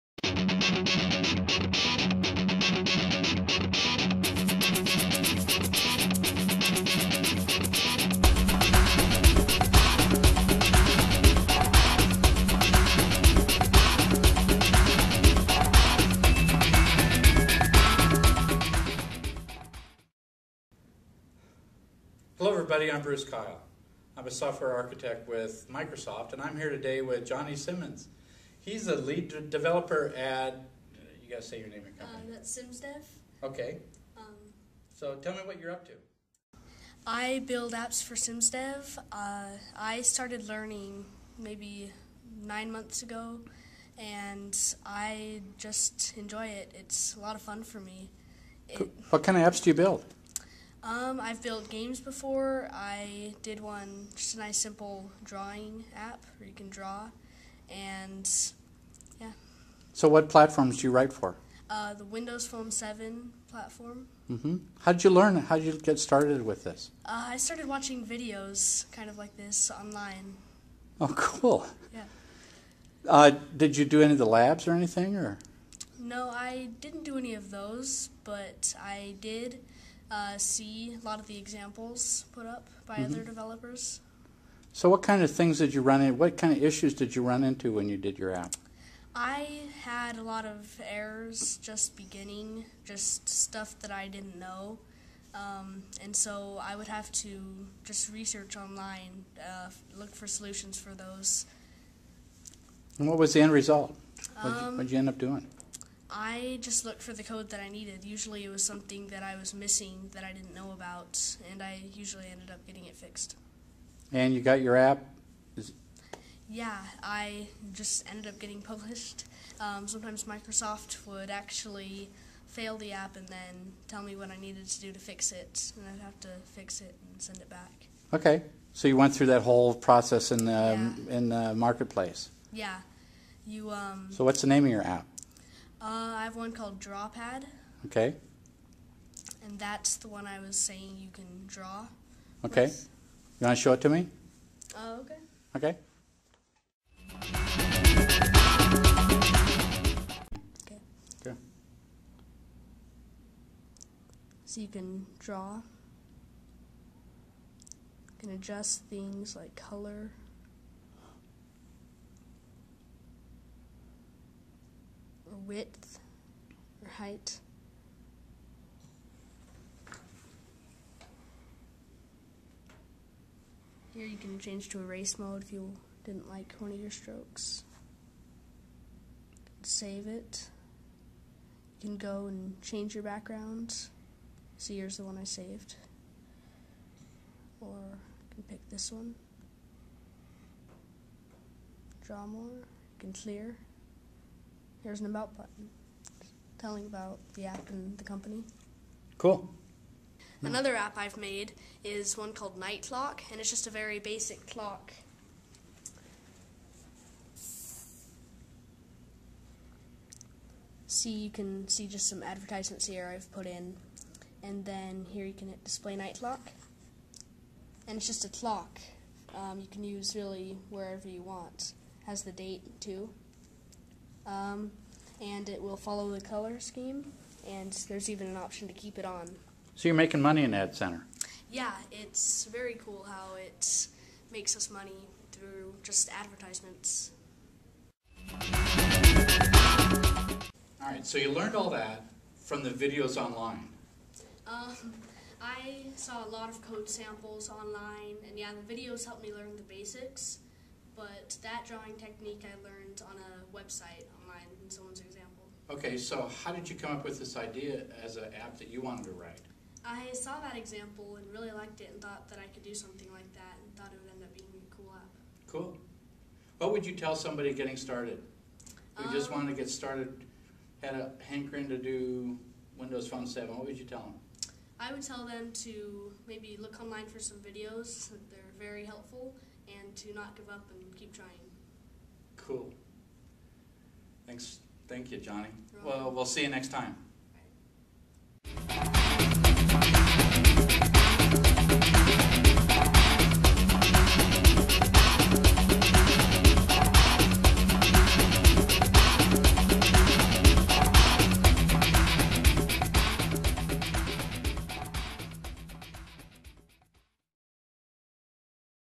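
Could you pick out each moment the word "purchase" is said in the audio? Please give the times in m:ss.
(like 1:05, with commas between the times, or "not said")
not said.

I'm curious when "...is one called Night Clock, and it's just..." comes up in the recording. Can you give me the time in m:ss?
3:21.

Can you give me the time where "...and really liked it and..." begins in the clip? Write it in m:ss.
4:21.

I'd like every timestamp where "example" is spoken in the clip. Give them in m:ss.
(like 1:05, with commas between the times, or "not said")
1:21, 4:15, 4:20.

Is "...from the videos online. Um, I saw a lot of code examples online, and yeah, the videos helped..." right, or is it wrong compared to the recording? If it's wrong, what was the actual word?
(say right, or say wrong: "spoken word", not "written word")
wrong: "samples", not "examples".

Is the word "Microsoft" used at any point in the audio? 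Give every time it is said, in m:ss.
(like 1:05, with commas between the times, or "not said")
0:25, 2:00.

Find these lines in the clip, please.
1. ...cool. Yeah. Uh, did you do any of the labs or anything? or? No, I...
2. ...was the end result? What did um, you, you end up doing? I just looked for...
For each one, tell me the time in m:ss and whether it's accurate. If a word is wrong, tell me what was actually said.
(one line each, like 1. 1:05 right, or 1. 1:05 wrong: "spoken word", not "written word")
1. 1:11 right
2. 1:43 right.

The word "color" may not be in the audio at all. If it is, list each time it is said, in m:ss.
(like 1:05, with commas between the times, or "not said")
2:39, 3:46.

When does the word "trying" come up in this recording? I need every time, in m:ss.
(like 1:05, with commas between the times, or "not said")
4:41.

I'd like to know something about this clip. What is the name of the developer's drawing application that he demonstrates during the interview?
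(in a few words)
Drawpad.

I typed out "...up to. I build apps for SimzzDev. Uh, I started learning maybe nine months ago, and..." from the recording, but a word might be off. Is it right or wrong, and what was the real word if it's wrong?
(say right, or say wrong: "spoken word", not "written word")
right.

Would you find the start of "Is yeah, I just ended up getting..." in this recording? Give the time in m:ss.
1:55.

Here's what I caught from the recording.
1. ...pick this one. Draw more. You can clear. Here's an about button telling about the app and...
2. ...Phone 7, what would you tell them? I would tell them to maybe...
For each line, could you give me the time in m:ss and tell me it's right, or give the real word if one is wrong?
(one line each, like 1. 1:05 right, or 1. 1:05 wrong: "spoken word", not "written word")
1. 3:08 right
2. 4:33 right.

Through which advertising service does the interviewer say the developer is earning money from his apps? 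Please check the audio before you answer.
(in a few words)
Ad Center.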